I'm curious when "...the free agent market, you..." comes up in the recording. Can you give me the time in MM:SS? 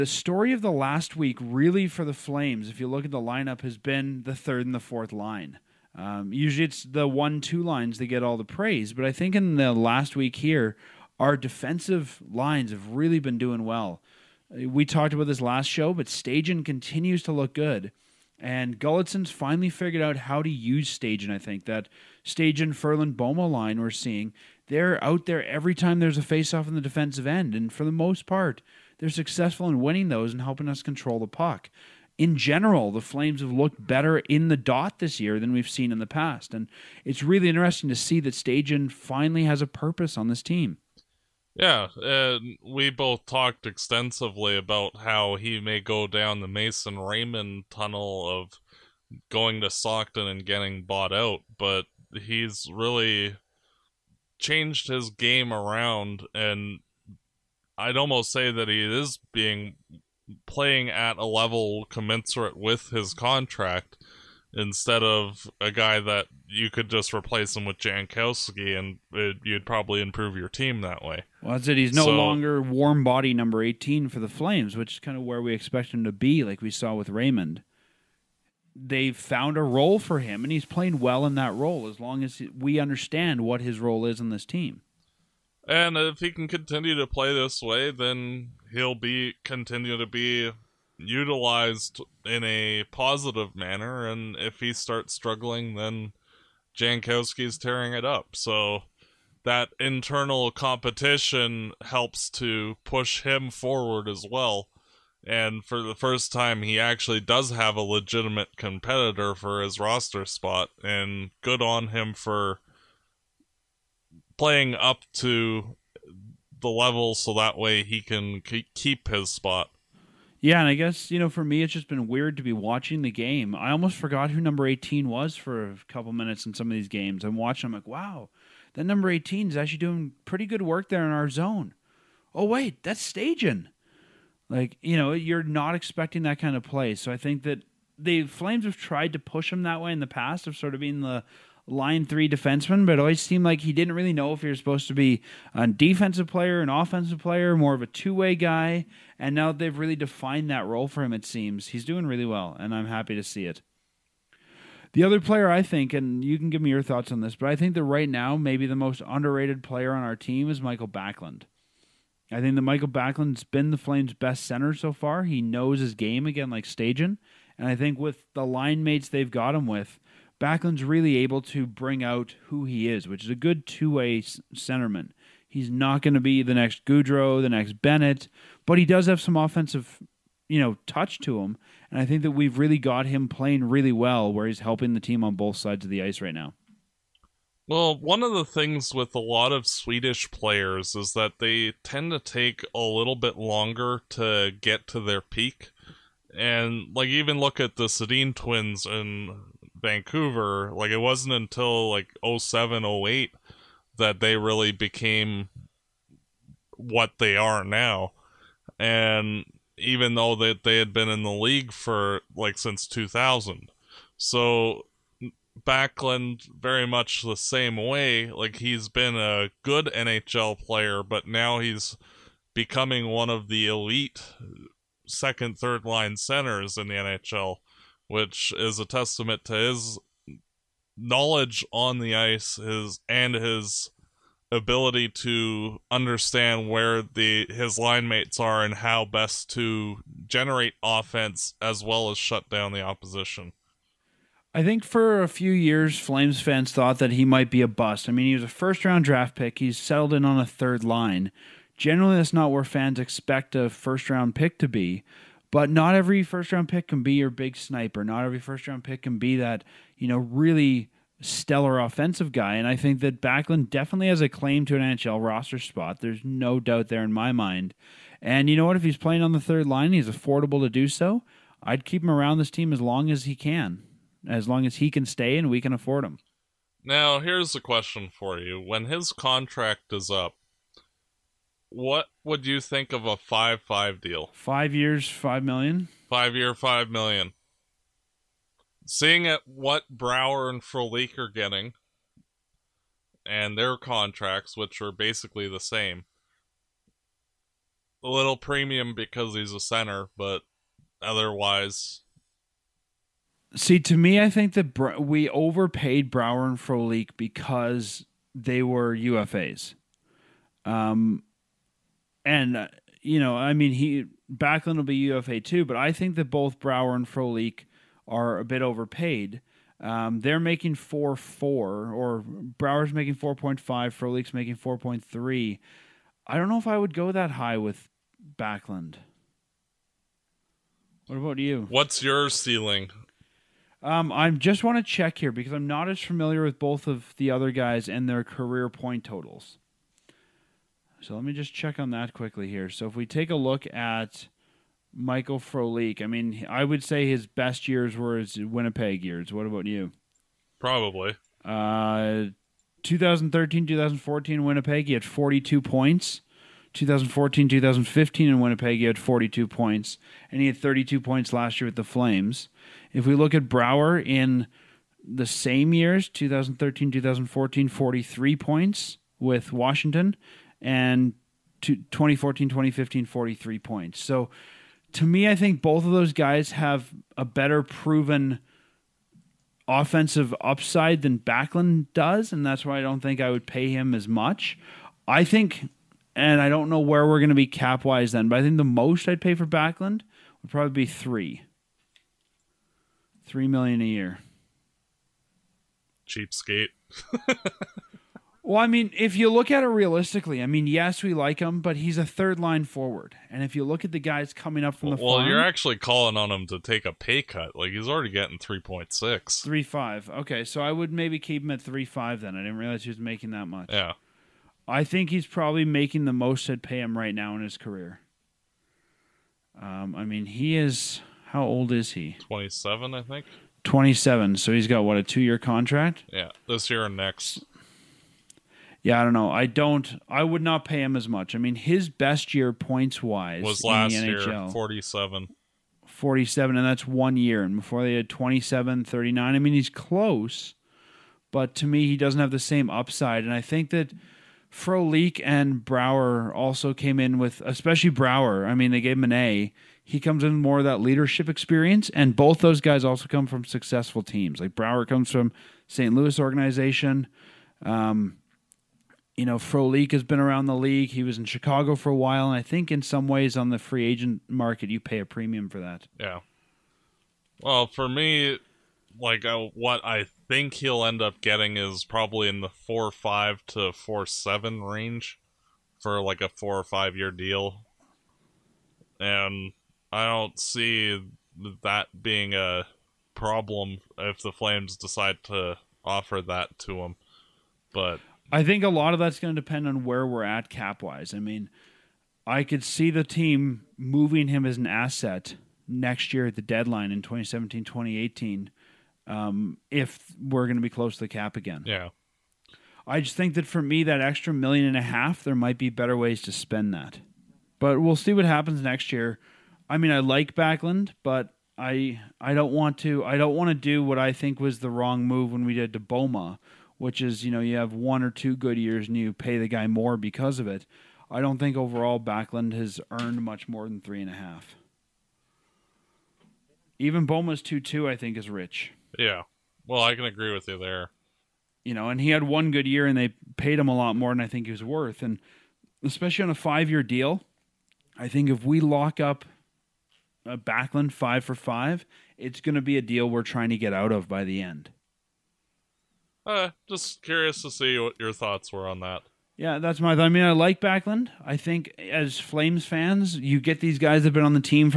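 07:43.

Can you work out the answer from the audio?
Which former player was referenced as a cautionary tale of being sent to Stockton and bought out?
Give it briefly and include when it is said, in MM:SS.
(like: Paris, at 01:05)
Mason Raymond, at 00:46.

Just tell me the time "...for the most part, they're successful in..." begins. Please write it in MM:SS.
00:27.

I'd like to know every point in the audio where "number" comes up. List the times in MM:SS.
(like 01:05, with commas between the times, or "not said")
01:13, 02:04, 02:08.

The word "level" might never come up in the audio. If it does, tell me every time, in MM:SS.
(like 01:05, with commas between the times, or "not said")
01:01, 01:56.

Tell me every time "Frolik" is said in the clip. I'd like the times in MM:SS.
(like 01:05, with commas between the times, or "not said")
04:50, 05:06, 05:17, 05:23, 05:45, 07:24, 07:39.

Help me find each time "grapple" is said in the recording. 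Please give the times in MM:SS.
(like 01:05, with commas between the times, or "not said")
not said.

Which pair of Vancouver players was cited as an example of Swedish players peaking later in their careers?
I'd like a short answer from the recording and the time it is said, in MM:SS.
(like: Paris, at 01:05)
Sedin twins, at 03:17.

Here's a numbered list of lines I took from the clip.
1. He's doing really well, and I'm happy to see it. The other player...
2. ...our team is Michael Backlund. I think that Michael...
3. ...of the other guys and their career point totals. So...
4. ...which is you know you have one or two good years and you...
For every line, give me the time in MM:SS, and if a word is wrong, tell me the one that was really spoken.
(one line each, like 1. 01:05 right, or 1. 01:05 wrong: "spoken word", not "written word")
1. 02:31 right
2. 02:40 right
3. 05:36 right
4. 08:36 right.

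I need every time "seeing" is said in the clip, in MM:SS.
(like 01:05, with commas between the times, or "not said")
00:23, 04:48.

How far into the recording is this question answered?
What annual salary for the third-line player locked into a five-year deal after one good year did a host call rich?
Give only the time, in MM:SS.
08:47.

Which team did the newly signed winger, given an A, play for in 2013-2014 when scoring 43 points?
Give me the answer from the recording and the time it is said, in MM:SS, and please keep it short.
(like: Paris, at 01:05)
Washington, at 06:09.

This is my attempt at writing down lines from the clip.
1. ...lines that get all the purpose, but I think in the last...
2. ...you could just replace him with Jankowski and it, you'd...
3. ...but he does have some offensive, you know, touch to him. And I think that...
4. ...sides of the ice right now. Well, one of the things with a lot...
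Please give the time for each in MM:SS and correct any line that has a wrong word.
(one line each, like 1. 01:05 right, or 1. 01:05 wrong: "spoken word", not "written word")
1. 00:07 wrong: "praise", not "purpose"
2. 01:06 right
3. 02:58 right
4. 03:05 right.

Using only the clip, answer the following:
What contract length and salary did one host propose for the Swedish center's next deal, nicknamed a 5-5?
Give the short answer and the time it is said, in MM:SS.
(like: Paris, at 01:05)
5 years, 5 million, at 04:44.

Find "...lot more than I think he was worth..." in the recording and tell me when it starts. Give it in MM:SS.
08:53.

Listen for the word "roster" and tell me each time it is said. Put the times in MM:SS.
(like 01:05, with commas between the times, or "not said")
01:49, 04:25.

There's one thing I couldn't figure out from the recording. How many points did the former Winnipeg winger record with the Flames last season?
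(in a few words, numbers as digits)
32.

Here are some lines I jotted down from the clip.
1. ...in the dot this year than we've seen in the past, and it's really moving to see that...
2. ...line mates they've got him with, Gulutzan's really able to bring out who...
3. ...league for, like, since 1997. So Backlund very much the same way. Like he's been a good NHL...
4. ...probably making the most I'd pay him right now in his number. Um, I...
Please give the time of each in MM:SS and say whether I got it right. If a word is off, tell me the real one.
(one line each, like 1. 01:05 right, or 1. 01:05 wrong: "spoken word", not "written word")
1. 00:34 wrong: "interesting", not "moving"
2. 02:48 wrong: "Backlund", not "Gulutzan"
3. 03:31 wrong: "2000", not "1997"
4. 06:55 wrong: "career", not "number".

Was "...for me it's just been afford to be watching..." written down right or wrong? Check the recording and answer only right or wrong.
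wrong.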